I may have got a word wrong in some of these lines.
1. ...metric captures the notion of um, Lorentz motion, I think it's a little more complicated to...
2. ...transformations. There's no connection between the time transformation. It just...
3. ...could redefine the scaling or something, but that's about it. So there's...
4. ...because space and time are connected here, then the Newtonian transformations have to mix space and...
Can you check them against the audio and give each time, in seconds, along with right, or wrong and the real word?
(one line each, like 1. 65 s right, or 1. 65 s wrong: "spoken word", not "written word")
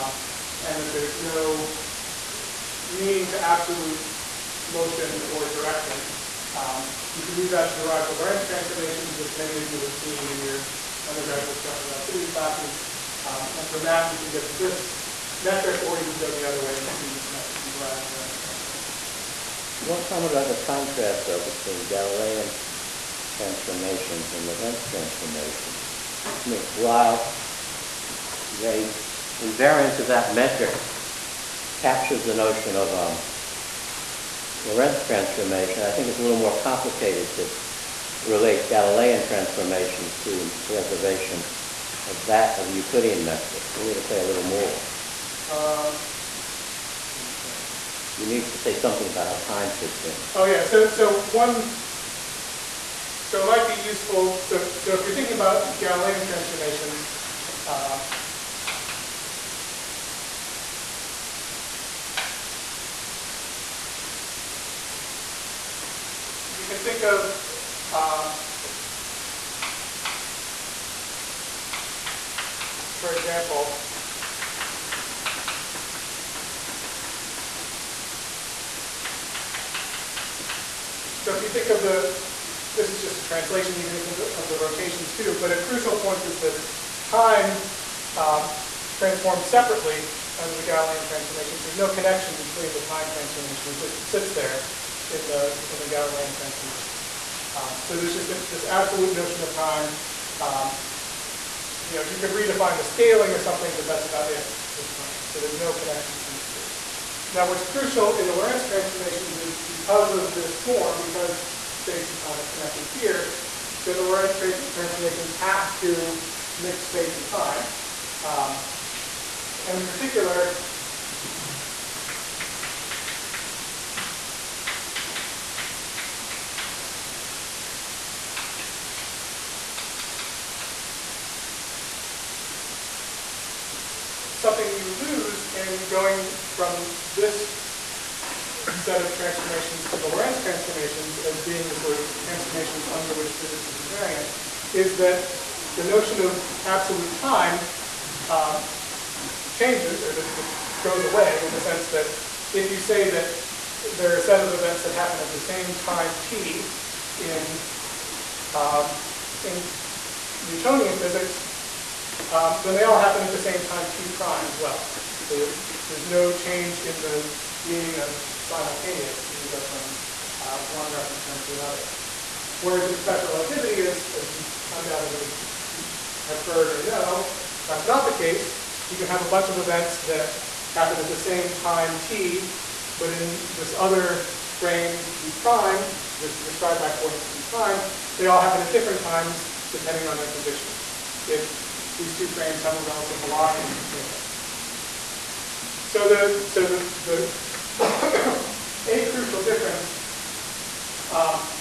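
1. 30 s wrong: "transformation", not "motion"
2. 91 s right
3. 102 s right
4. 111 s wrong: "Lorentz", not "Newtonian".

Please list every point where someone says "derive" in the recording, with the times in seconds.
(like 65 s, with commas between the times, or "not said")
7 s, 17 s.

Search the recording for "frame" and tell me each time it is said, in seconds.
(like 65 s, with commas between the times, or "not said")
171 s, 184 s, 192 s.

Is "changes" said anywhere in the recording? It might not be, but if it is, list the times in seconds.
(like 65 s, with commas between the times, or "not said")
149 s, 166 s.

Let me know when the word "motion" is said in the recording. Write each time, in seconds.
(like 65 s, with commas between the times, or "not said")
4 s.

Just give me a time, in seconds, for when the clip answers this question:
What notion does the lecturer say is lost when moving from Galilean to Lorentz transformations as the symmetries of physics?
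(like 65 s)
146 s.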